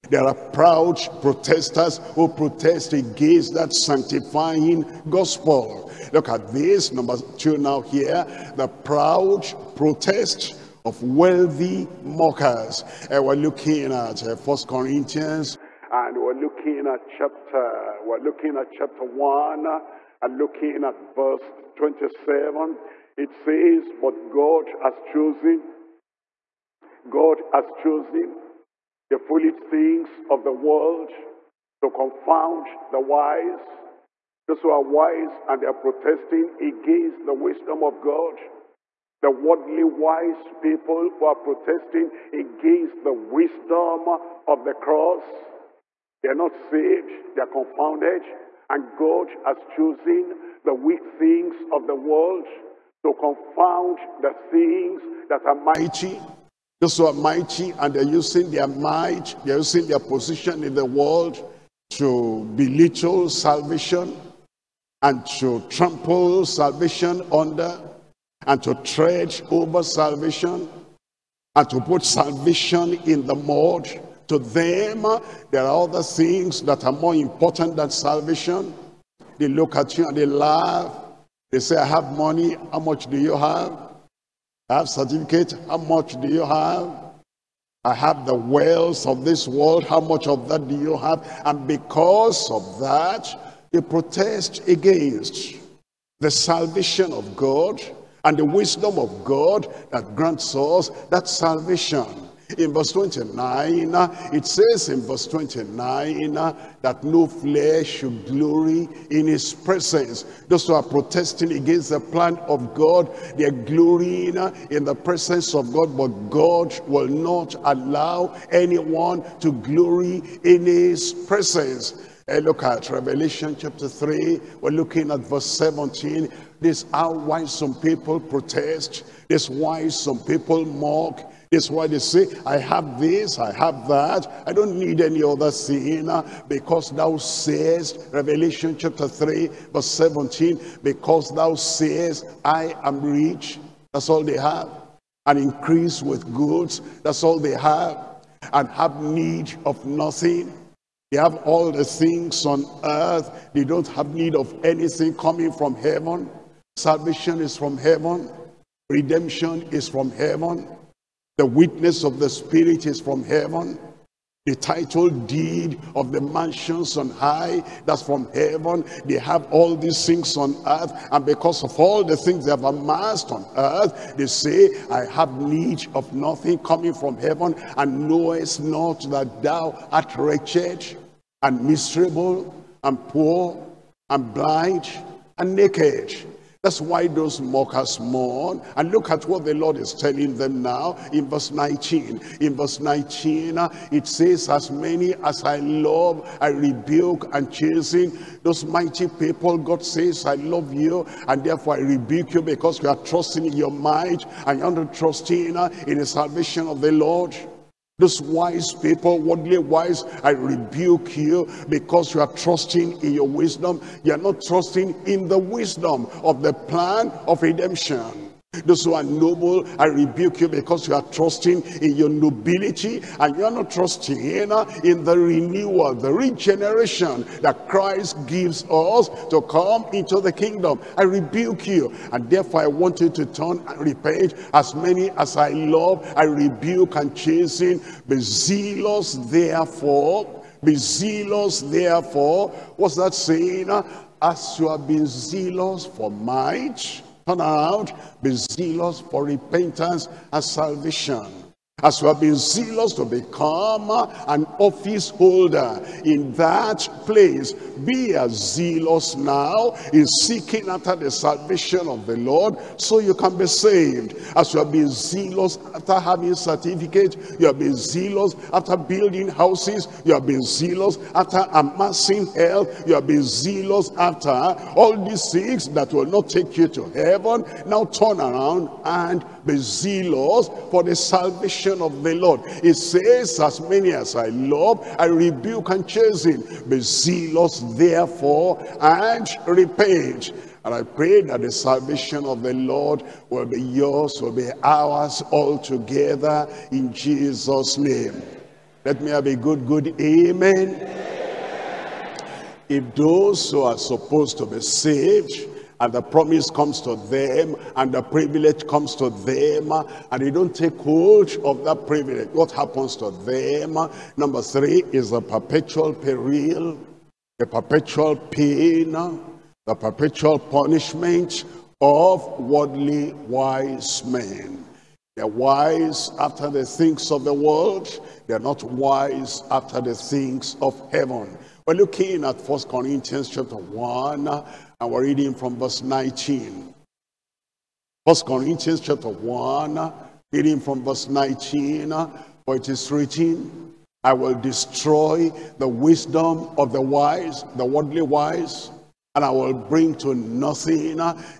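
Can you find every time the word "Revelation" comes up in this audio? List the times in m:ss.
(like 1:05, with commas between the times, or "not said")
2:02, 2:18.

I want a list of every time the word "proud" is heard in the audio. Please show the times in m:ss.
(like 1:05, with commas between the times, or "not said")
0:00, 0:08.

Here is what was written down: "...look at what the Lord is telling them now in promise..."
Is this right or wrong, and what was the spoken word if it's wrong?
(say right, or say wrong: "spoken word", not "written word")
wrong: "verse", not "promise".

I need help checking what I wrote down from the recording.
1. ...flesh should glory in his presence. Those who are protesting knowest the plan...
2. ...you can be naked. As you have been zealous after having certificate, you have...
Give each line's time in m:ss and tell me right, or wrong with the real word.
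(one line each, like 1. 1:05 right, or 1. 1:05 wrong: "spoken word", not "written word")
1. 1:47 wrong: "against", not "knowest"
2. 4:22 wrong: "saved", not "naked".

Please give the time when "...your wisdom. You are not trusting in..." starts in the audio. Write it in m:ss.
3:33.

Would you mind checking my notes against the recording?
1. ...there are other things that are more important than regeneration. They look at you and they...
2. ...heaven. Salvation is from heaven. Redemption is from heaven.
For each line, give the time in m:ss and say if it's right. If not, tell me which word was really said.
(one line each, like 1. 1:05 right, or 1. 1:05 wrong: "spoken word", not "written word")
1. 1:15 wrong: "salvation", not "regeneration"
2. 2:35 right.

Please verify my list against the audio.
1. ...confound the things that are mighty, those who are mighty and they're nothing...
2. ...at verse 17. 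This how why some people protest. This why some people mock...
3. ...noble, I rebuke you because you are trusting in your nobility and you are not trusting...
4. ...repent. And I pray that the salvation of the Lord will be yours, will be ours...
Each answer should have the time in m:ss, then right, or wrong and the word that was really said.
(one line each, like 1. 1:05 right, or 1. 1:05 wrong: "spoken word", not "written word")
1. 0:53 wrong: "using", not "nothing"
2. 2:05 right
3. 3:39 right
4. 4:49 right.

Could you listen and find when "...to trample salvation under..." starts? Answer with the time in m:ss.
1:05.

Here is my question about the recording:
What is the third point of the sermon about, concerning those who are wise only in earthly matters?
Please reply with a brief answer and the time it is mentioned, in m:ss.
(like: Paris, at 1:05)
perpetual punishment, at 5:18.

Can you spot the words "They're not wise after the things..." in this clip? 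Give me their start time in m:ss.
5:28.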